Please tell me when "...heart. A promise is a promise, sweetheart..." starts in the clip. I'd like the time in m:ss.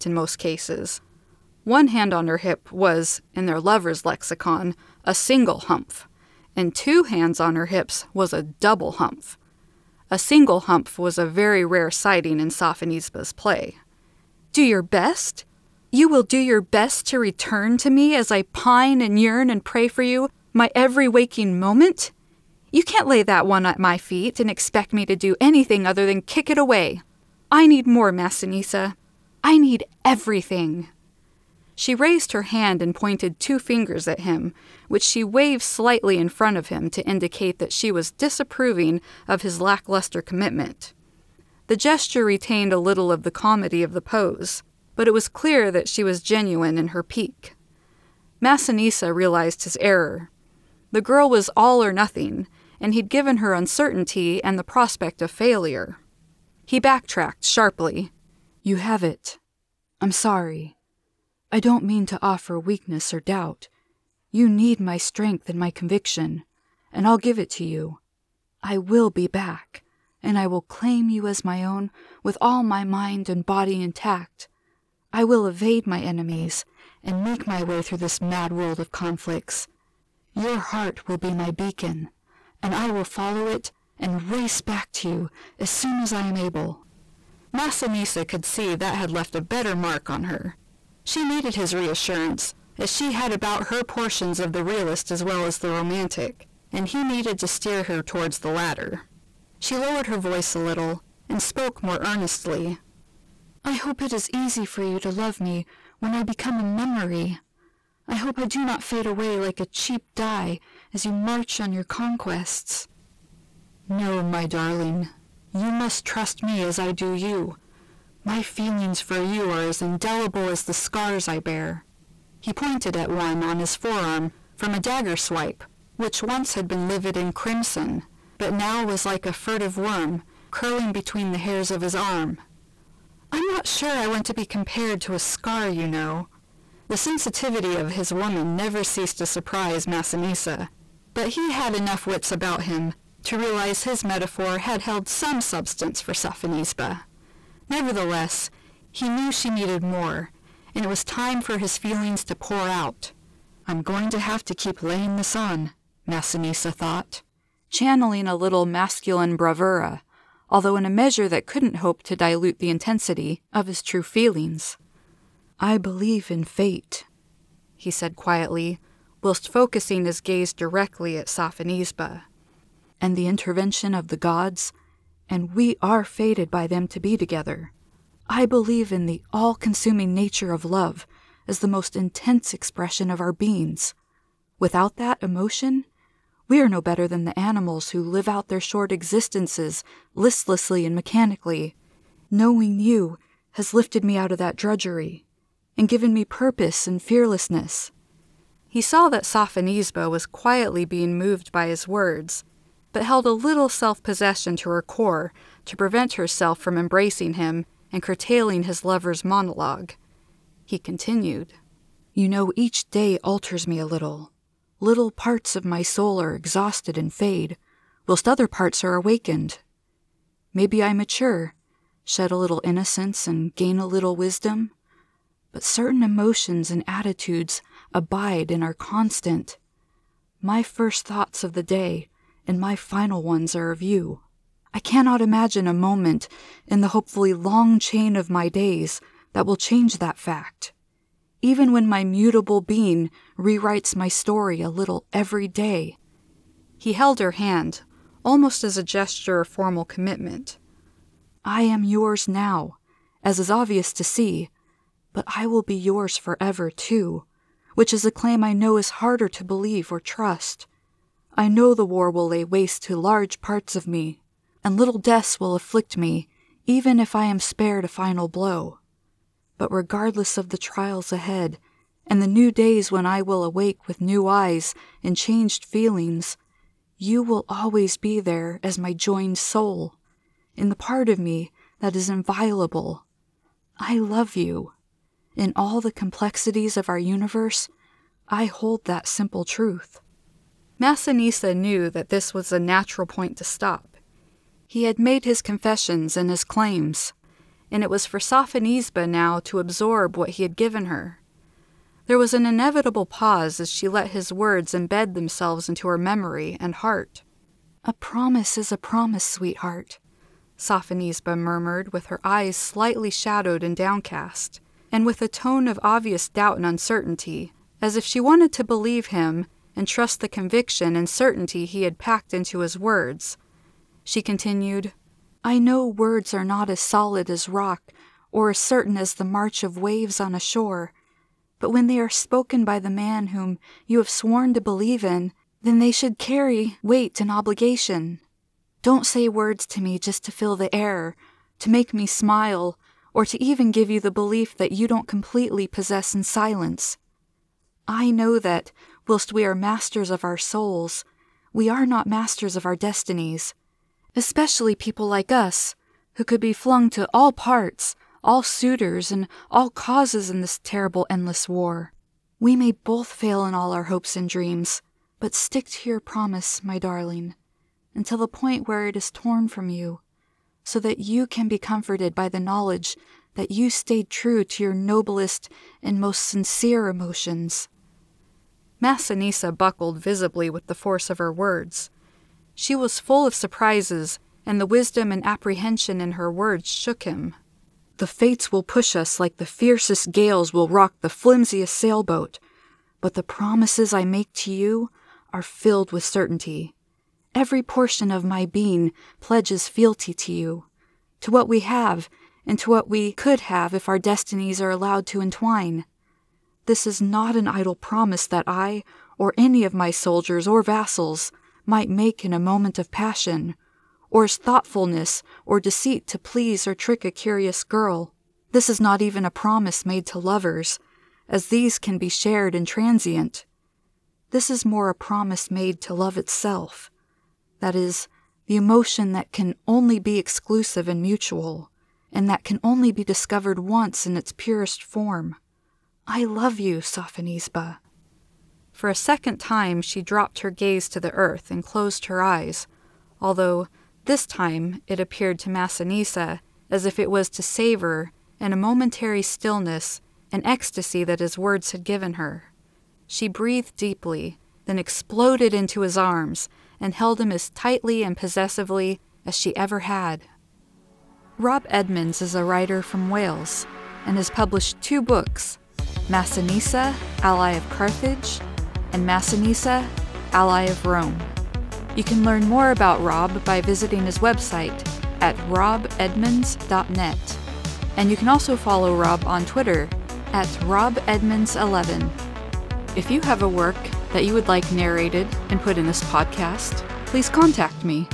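5:06.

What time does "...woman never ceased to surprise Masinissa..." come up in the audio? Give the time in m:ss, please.
2:18.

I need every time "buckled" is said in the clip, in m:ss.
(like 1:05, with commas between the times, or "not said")
6:19.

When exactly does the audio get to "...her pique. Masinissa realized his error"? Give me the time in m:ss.
0:46.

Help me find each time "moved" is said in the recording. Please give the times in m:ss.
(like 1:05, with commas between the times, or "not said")
3:21.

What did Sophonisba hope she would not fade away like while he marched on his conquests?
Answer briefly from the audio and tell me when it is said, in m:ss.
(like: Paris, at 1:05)
a cheap dye, at 1:49.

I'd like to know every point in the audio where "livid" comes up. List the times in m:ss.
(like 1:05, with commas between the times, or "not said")
2:06.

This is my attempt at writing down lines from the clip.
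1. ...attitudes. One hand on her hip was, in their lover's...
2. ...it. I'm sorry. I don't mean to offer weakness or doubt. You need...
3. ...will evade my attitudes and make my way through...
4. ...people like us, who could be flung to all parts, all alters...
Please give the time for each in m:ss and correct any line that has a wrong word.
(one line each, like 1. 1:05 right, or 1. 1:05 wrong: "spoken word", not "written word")
1. 0:00 wrong: "cases", not "attitudes"
2. 0:59 right
3. 1:15 wrong: "enemies", not "attitudes"
4. 5:54 wrong: "suitors", not "alters".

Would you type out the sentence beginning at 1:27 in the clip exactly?
Masinissa could see that had left a better mark on her.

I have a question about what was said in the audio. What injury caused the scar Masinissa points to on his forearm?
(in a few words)
a dagger swipe.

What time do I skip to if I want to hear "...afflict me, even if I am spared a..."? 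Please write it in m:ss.
4:25.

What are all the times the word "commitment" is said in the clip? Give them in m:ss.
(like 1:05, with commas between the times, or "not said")
0:40, 4:09.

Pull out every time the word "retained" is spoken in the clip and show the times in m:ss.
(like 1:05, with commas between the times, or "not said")
0:42.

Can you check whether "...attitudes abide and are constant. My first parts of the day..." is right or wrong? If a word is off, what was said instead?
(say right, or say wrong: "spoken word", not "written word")
wrong: "thoughts", not "parts".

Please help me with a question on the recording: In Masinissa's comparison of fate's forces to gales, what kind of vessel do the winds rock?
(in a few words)
the flimsiest sailboat.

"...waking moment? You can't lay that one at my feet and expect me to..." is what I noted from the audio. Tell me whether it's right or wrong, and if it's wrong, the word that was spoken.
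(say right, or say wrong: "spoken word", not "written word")
right.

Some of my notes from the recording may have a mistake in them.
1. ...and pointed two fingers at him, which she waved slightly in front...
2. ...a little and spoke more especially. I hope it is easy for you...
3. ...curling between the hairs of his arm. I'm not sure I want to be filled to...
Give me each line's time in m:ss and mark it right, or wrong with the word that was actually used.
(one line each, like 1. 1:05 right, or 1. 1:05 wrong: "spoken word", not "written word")
1. 0:32 right
2. 1:40 wrong: "earnestly", not "especially"
3. 2:10 wrong: "compared", not "filled".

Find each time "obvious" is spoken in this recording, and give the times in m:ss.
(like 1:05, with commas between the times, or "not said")
4:13, 5:15.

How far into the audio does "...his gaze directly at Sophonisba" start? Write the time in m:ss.
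2:50.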